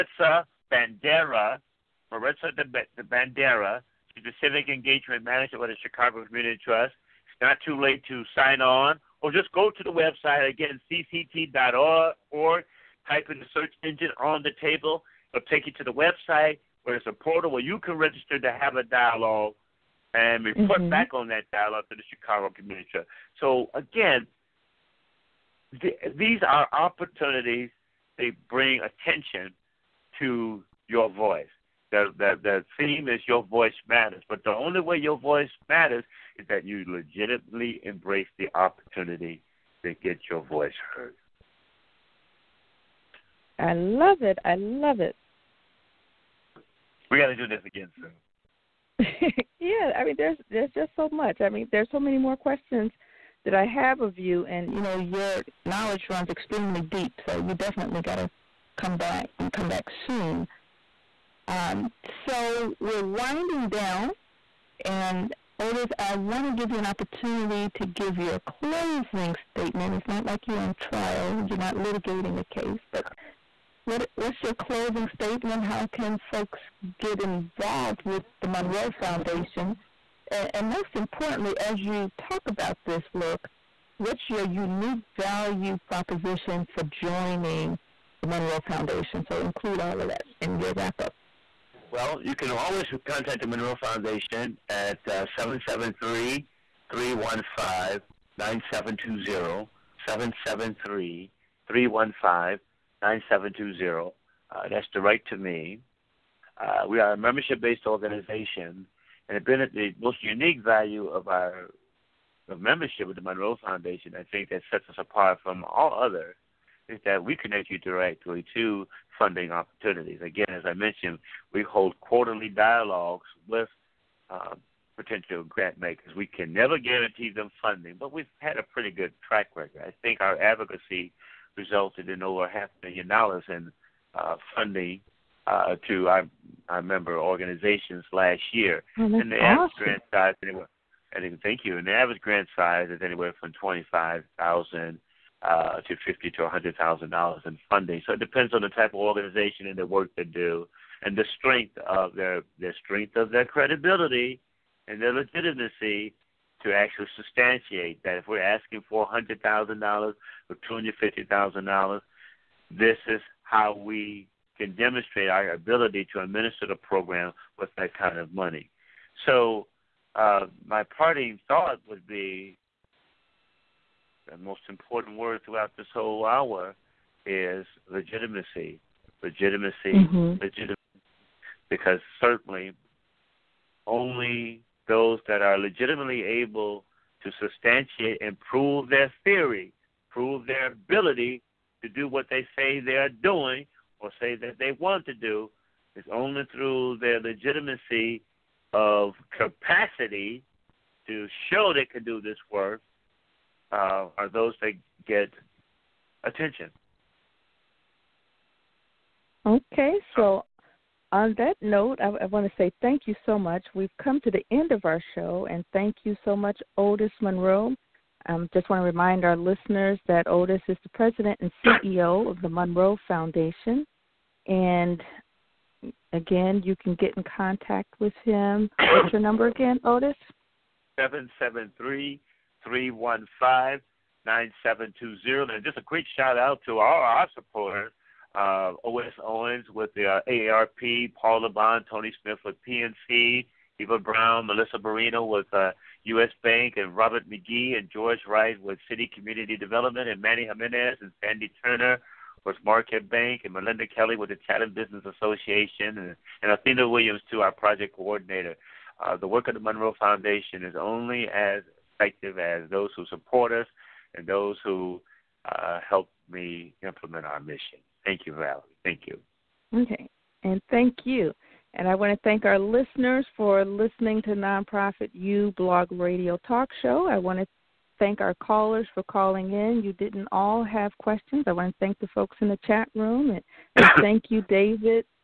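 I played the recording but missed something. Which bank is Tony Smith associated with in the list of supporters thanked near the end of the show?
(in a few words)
PNC.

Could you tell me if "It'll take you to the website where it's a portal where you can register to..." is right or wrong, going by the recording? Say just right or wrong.
right.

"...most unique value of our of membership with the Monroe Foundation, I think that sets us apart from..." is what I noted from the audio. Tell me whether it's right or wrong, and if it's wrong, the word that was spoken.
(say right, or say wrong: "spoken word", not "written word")
right.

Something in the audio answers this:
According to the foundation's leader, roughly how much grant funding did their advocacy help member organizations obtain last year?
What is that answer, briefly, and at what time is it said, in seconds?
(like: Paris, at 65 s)
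over half a million dollars, at 132 s.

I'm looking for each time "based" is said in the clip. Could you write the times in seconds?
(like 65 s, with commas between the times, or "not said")
107 s.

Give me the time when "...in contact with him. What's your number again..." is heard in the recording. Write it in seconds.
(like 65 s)
227 s.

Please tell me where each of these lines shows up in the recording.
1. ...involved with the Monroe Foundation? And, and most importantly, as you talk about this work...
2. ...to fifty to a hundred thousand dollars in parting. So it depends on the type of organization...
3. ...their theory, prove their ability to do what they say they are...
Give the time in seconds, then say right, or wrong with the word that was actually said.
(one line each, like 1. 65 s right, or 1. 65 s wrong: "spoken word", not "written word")
1. 77 s right
2. 145 s wrong: "funding", not "parting"
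3. 188 s right.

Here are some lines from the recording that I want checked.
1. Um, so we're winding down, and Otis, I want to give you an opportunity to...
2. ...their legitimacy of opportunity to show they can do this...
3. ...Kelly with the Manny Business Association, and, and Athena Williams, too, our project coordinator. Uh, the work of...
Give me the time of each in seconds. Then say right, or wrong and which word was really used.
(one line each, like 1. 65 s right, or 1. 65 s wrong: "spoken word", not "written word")
1. 61 s right
2. 196 s wrong: "capacity", not "opportunity"
3. 253 s wrong: "Chatham", not "Manny".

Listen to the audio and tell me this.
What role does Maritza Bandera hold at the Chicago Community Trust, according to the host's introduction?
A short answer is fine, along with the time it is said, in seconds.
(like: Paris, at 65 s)
Civic Engagement Manager, at 4 s.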